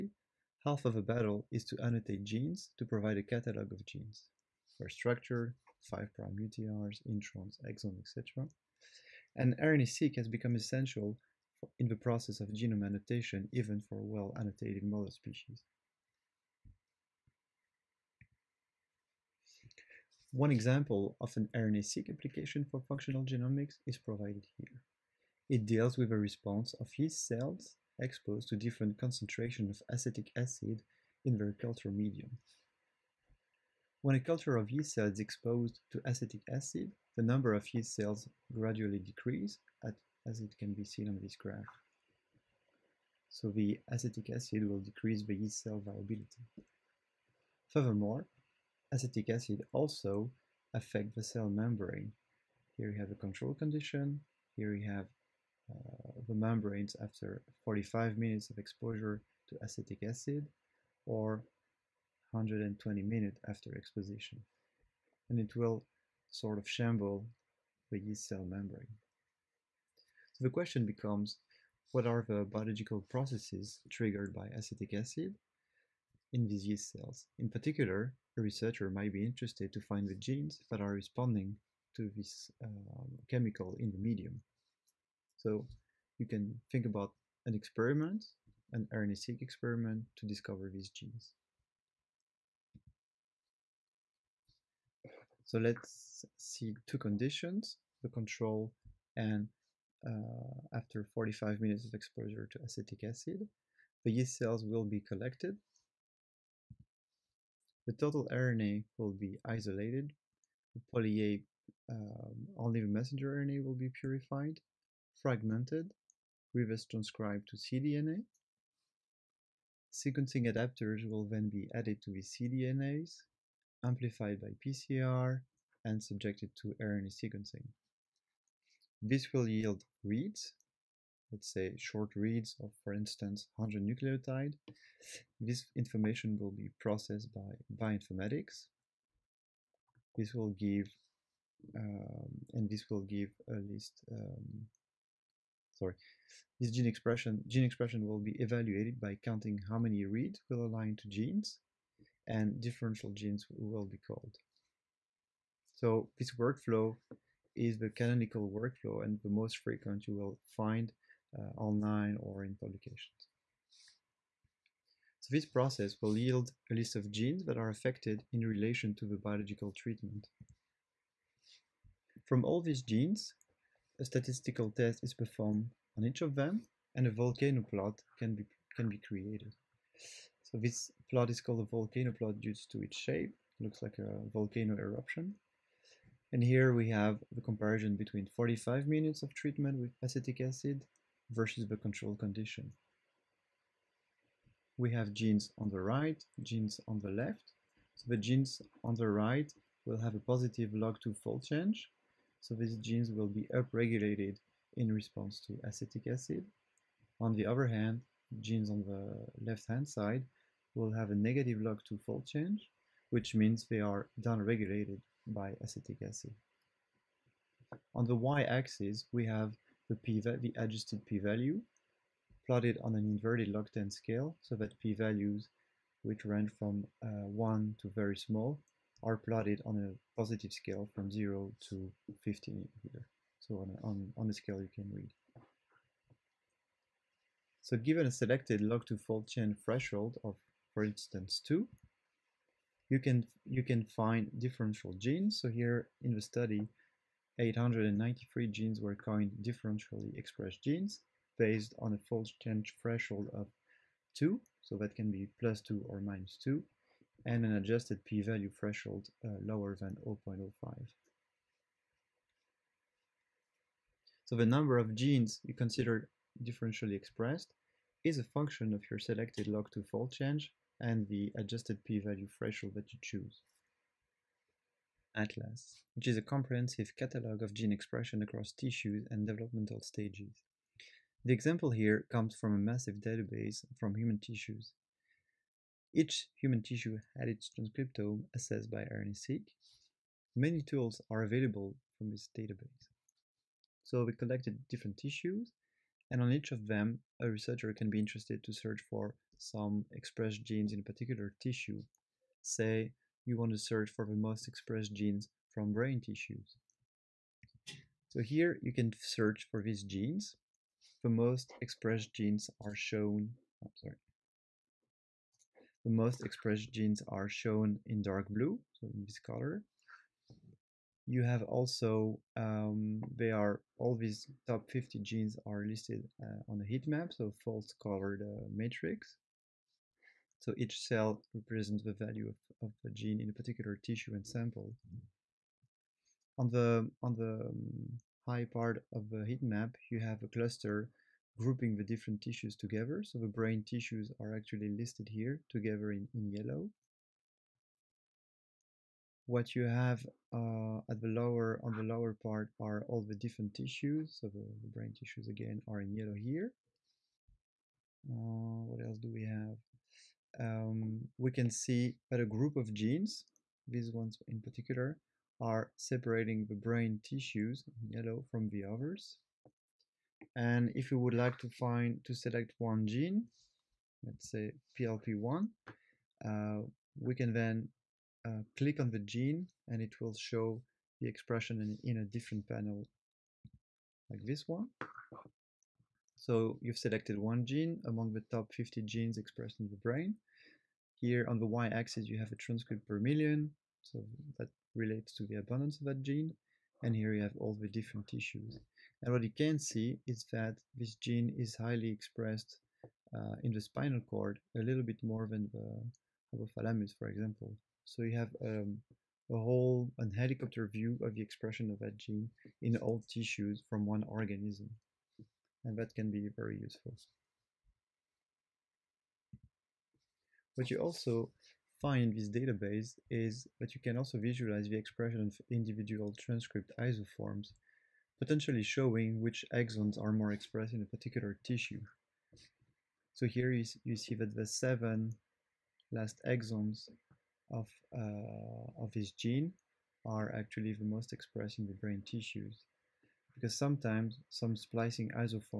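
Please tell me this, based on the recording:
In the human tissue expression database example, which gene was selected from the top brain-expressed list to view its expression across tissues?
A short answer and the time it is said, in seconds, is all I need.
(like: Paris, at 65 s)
PLP1, at 374 s.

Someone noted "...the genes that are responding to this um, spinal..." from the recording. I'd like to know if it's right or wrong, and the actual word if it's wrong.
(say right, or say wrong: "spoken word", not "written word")
wrong: "chemical", not "spinal".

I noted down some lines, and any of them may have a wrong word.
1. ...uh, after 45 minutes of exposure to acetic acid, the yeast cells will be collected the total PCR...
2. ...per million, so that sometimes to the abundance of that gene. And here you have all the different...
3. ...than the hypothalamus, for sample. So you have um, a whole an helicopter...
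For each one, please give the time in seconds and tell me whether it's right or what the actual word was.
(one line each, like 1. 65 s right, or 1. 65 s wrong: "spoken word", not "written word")
1. 100 s wrong: "RNA", not "PCR"
2. 392 s wrong: "relates", not "sometimes"
3. 405 s wrong: "example", not "sample".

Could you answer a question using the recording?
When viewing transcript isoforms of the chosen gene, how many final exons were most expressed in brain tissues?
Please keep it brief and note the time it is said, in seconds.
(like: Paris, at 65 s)
7, at 434 s.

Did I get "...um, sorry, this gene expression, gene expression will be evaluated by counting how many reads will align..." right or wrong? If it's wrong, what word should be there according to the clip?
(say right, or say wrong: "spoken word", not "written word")
right.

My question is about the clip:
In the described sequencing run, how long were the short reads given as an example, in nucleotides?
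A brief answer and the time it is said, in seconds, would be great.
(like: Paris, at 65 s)
100, at 133 s.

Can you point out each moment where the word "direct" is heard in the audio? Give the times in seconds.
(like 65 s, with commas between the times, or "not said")
not said.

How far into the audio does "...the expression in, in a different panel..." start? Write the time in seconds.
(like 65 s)
381 s.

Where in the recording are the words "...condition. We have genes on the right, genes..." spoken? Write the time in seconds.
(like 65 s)
192 s.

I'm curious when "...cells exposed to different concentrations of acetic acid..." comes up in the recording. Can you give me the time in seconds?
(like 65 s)
27 s.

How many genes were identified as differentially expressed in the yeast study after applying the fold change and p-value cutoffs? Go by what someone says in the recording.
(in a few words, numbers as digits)
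893.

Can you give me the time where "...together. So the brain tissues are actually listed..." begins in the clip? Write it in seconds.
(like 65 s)
342 s.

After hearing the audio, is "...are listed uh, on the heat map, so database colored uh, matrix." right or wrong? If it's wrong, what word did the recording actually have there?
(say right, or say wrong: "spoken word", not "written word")
wrong: "false", not "database".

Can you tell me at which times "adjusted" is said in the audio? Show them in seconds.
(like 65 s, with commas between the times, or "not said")
220 s, 257 s, 271 s.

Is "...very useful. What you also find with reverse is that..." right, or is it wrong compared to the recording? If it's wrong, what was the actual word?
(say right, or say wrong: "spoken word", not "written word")
wrong: "database", not "reverse".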